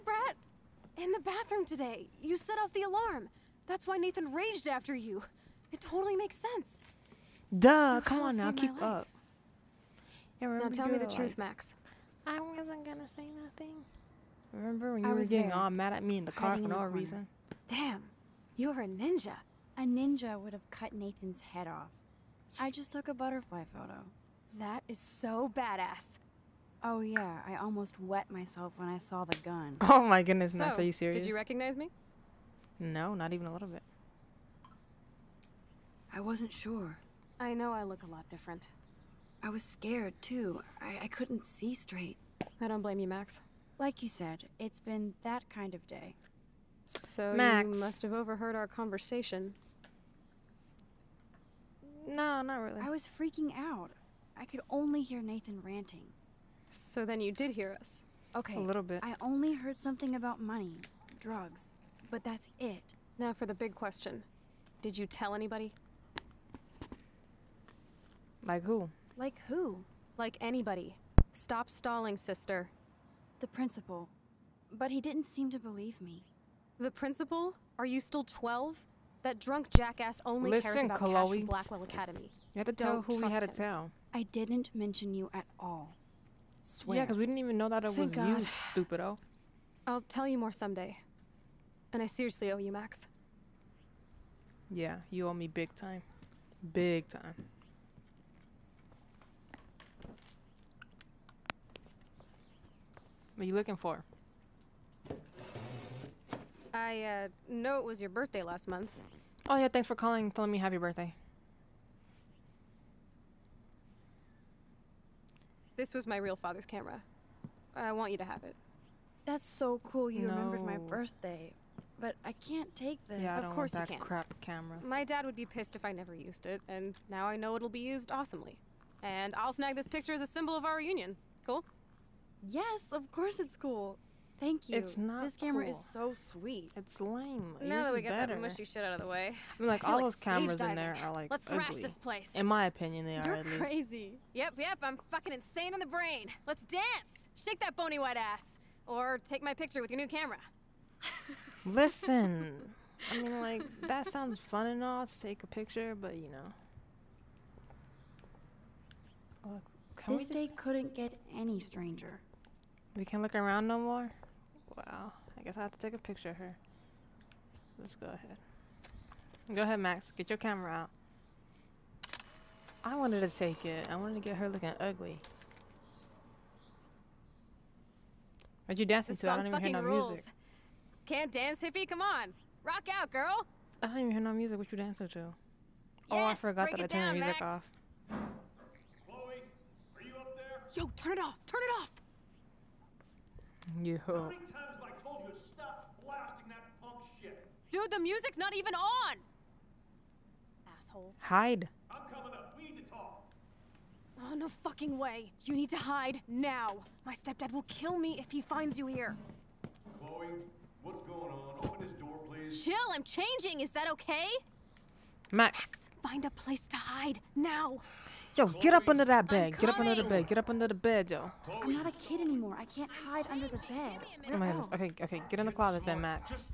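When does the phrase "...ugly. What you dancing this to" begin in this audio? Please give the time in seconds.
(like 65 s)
174 s.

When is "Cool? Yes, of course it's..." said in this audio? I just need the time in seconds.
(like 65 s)
131 s.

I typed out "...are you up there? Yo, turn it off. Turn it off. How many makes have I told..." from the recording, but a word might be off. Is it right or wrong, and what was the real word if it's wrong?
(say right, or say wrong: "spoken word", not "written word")
wrong: "times", not "makes".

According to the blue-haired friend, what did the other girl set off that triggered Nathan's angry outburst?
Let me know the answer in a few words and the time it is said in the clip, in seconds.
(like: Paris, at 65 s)
The alarm, at 2 s.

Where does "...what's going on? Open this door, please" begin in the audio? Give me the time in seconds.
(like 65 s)
210 s.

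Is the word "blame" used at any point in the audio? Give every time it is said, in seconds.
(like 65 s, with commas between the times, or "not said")
42 s.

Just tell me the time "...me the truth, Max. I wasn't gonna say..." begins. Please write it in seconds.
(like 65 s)
10 s.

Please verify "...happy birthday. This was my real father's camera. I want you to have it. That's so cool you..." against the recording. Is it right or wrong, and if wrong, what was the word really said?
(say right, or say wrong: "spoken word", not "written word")
right.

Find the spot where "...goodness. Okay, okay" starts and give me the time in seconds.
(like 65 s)
224 s.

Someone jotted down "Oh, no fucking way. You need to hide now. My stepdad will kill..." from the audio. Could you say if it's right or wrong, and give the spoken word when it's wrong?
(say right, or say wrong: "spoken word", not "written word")
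right.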